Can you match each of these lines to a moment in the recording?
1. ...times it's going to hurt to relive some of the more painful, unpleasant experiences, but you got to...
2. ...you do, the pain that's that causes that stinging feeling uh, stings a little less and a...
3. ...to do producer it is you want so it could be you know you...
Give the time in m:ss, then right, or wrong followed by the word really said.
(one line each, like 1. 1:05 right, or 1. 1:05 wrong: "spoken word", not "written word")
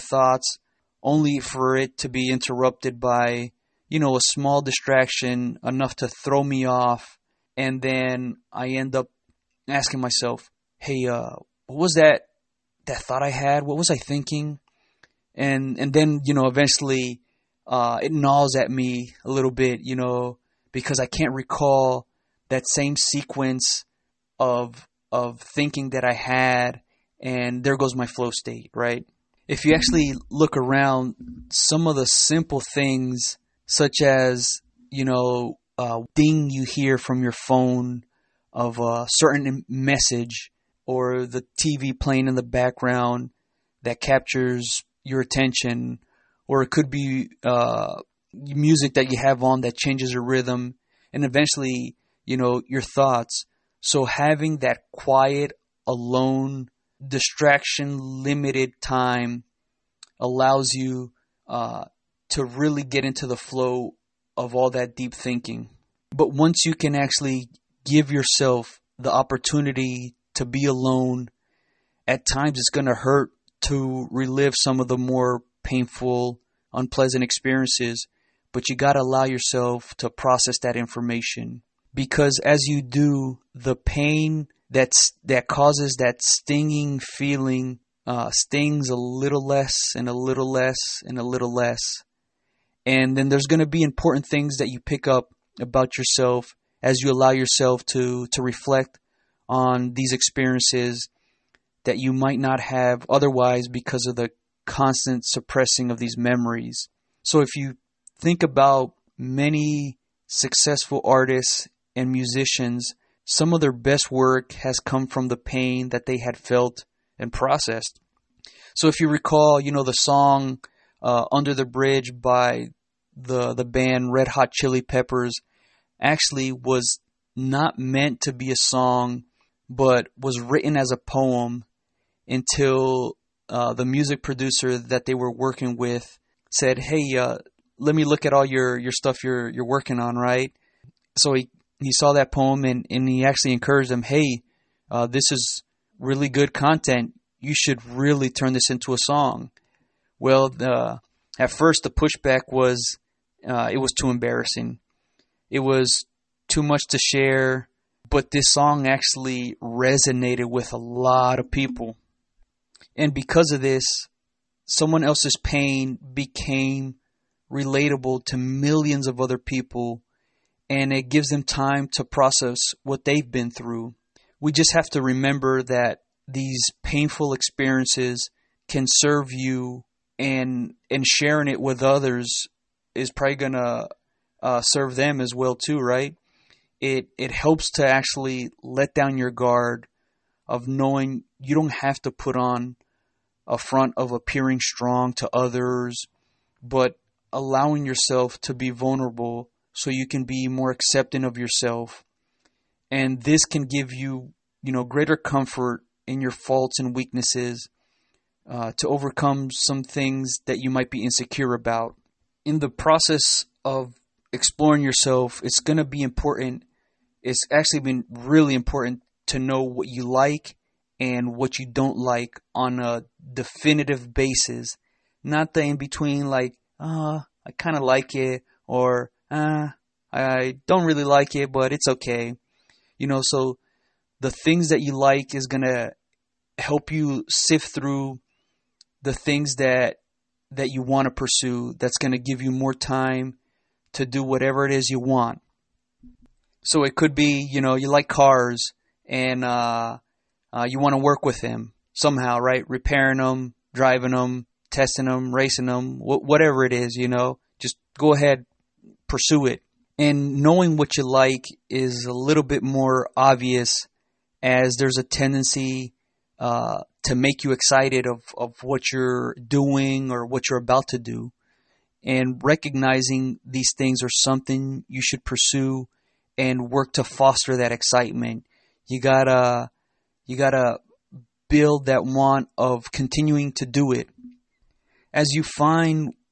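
1. 1:12 right
2. 1:22 right
3. 4:03 wrong: "whatever", not "producer".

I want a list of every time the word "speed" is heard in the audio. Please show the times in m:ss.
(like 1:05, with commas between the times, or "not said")
not said.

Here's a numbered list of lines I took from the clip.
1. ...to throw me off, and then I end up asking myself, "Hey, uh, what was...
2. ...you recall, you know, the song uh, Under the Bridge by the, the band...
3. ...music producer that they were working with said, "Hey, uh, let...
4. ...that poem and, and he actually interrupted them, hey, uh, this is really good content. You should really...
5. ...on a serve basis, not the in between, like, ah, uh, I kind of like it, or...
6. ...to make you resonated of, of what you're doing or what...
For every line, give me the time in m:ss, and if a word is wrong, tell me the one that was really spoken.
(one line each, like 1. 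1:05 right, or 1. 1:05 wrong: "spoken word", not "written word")
1. 0:05 right
2. 1:58 right
3. 2:13 right
4. 2:22 wrong: "encouraged", not "interrupted"
5. 3:42 wrong: "definitive", not "serve"
6. 4:27 wrong: "excited", not "resonated".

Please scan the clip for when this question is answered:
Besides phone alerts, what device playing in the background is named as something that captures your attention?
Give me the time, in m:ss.
0:41.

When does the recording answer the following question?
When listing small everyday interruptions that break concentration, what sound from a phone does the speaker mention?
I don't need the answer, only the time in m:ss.
0:36.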